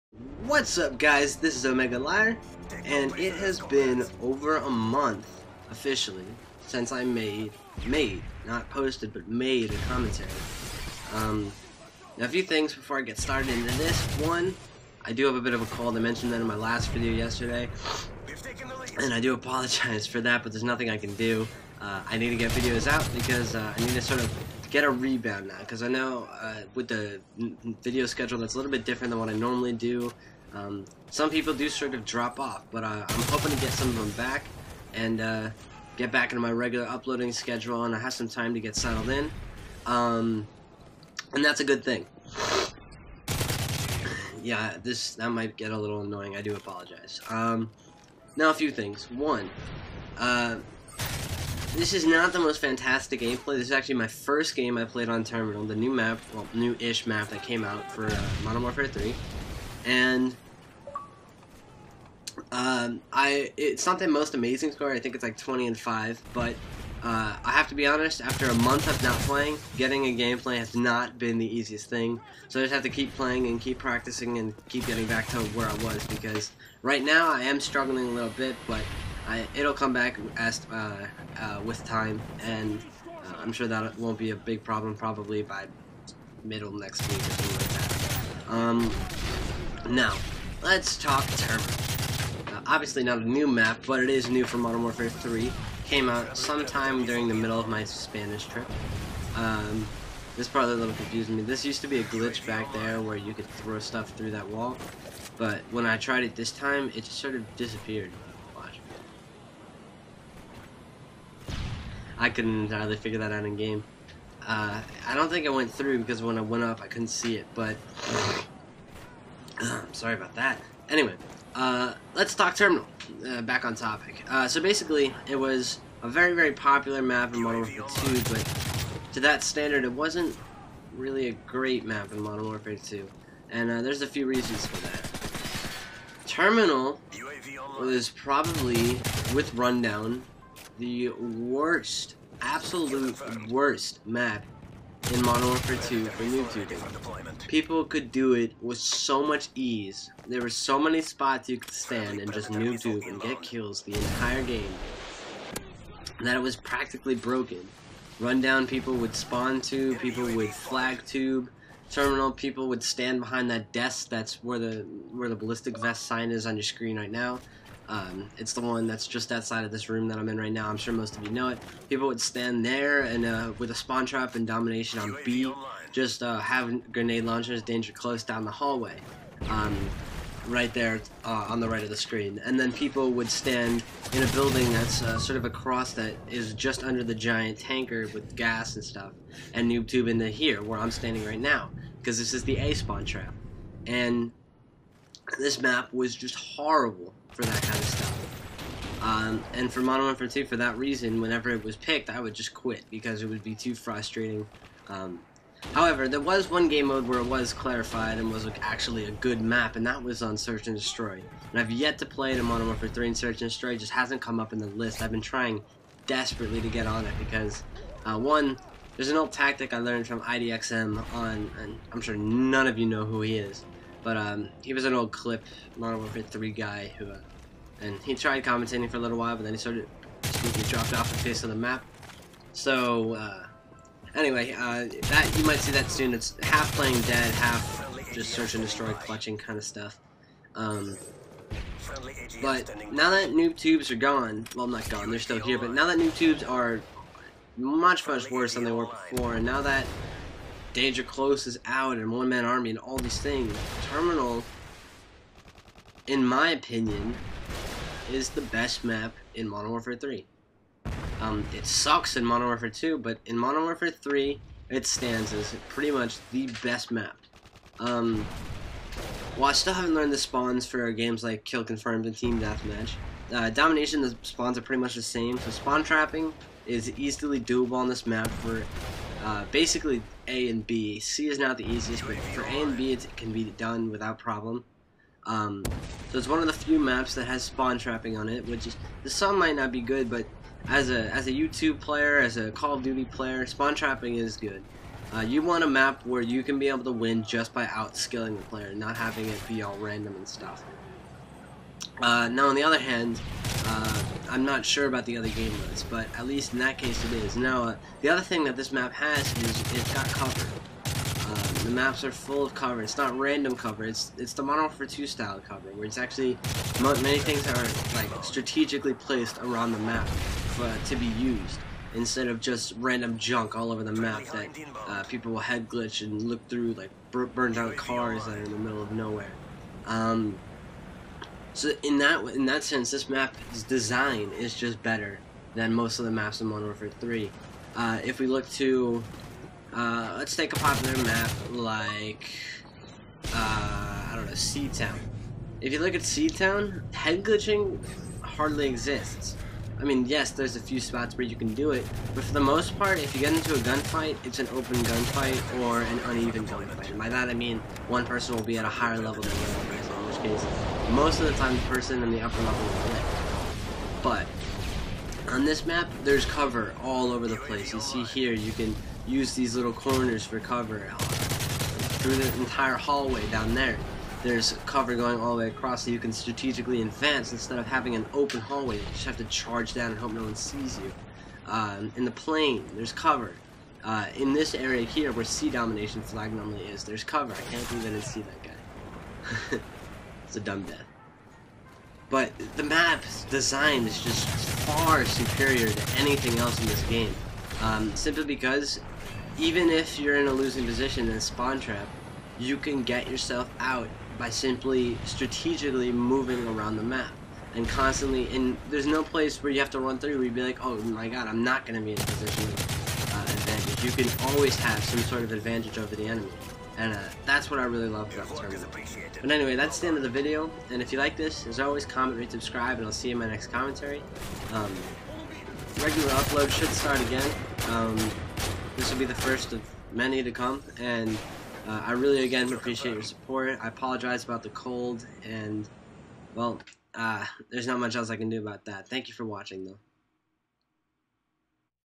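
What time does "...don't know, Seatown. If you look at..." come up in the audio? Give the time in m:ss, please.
5:44.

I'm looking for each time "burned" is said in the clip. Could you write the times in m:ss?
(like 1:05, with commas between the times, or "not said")
5:27.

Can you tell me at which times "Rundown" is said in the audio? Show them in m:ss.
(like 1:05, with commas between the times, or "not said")
2:19, 2:38.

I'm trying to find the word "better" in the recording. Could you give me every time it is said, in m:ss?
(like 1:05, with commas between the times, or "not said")
5:34.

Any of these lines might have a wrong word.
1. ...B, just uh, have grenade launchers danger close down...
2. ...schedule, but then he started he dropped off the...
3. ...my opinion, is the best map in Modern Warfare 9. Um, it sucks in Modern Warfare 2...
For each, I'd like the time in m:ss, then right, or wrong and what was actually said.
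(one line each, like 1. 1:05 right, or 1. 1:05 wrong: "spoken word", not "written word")
1. 2:55 right
2. 3:49 wrong: "while", not "schedule"
3. 4:16 wrong: "3", not "9".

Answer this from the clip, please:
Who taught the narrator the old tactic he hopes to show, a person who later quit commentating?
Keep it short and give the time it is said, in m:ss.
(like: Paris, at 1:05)
IDXM, at 3:40.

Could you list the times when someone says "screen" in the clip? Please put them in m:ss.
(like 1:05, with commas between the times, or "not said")
2:46, 3:01.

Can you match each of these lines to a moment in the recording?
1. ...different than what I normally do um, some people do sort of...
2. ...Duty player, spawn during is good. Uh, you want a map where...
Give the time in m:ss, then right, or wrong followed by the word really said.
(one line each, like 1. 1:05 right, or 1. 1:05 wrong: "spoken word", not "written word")
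1. 0:28 right
2. 4:52 wrong: "trapping", not "during".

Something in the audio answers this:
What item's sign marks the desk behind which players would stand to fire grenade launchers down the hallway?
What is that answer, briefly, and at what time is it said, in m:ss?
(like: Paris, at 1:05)
ballistic vest, at 2:45.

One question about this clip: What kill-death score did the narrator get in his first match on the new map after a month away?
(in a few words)
20 and 5.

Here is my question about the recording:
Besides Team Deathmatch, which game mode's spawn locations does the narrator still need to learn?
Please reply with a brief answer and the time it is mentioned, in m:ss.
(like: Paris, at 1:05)
Kill Confirmed, at 4:31.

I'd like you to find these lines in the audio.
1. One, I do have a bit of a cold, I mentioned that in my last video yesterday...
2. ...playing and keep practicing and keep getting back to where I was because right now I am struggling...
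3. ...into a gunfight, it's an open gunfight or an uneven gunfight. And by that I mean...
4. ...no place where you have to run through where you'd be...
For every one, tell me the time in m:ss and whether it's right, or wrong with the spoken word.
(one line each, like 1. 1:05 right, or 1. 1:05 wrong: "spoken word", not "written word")
1. 0:14 right
2. 1:13 right
3. 5:53 right
4. 6:48 right.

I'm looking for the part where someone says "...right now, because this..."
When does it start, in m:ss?
3:11.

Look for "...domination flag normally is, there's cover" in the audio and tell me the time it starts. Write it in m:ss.
6:25.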